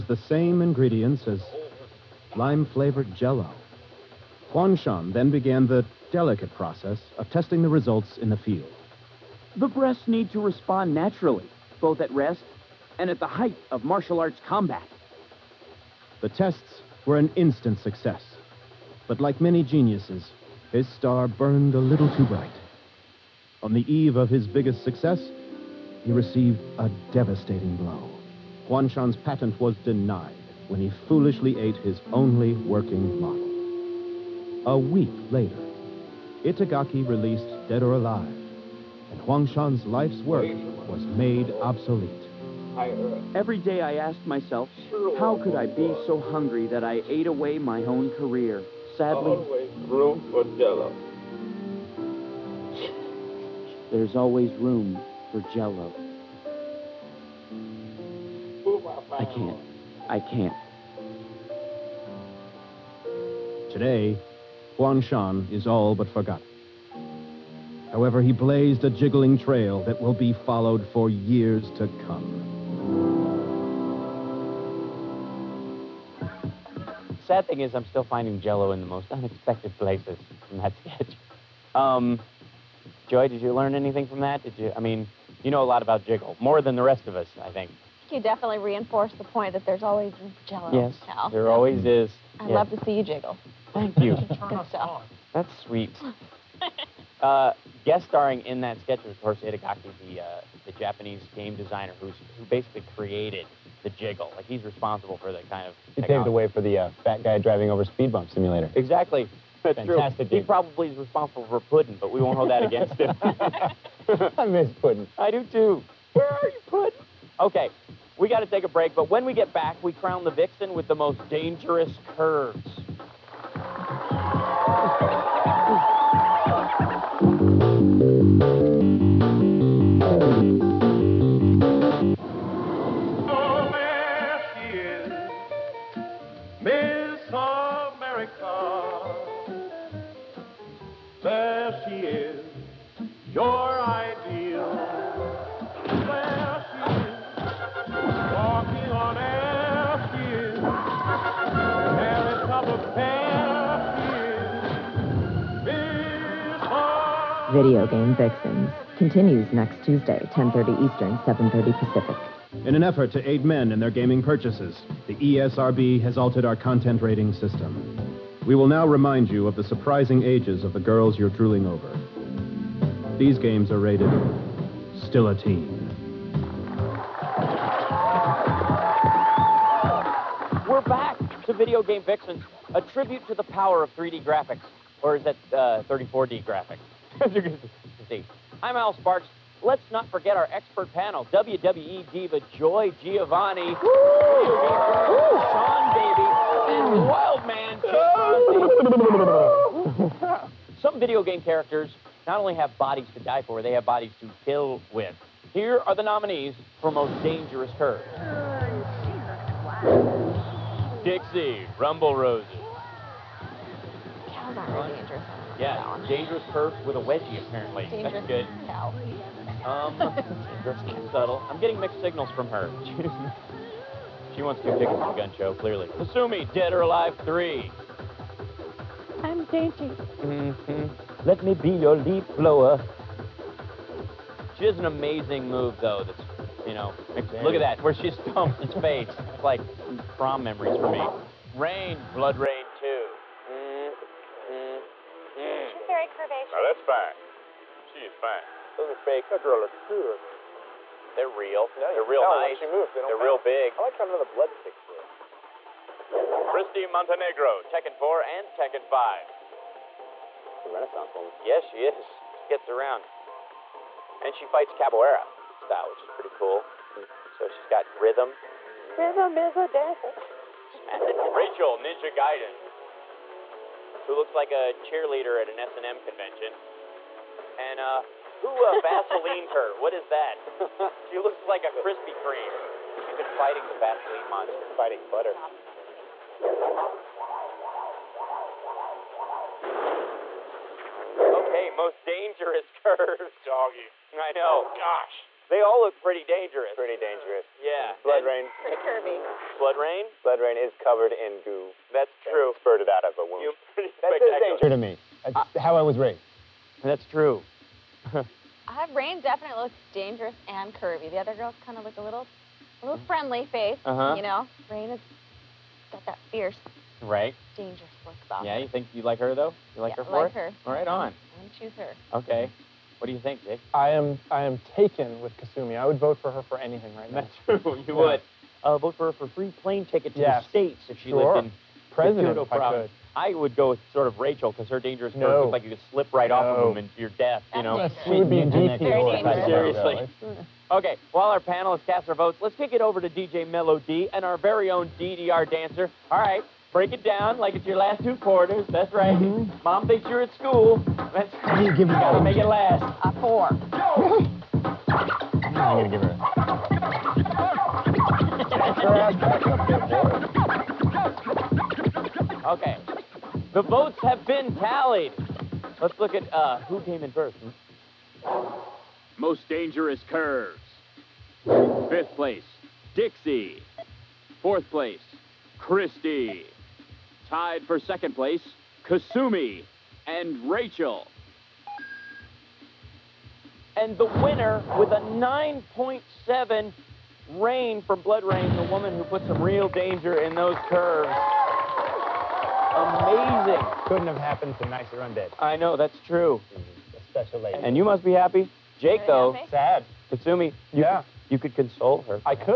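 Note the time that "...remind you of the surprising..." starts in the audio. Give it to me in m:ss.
2:48.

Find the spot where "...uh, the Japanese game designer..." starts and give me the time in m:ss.
1:40.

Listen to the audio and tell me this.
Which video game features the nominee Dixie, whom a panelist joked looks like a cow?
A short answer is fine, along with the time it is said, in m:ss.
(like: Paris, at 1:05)
Rumble Roses, at 3:31.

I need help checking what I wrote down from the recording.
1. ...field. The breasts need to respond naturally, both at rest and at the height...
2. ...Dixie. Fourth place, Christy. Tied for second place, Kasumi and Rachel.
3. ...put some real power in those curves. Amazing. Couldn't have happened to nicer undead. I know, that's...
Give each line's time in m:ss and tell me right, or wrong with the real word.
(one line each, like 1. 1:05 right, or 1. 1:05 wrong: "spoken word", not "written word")
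1. 0:08 right
2. 6:12 right
3. 6:29 wrong: "danger", not "power".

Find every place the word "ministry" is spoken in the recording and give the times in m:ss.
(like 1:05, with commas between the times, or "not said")
not said.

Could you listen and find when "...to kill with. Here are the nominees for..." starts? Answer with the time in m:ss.
3:24.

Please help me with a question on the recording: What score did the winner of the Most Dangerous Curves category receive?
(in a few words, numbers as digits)
9.7.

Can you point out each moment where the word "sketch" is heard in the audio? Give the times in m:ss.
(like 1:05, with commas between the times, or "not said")
1:20, 1:38.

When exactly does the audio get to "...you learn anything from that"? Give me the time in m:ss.
1:23.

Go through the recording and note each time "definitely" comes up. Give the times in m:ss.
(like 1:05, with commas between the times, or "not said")
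1:28, 5:09.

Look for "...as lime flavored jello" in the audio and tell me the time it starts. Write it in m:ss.
0:01.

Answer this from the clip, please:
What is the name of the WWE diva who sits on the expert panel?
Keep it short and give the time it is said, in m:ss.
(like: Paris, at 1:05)
Joy Giovanni, at 3:12.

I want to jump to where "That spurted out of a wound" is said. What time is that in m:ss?
5:02.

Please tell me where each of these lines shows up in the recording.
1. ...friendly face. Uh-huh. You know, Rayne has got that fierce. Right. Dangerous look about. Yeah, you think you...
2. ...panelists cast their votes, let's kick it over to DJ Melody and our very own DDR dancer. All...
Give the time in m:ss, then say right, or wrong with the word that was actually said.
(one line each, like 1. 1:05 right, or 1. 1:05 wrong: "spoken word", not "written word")
1. 5:13 right
2. 5:41 right.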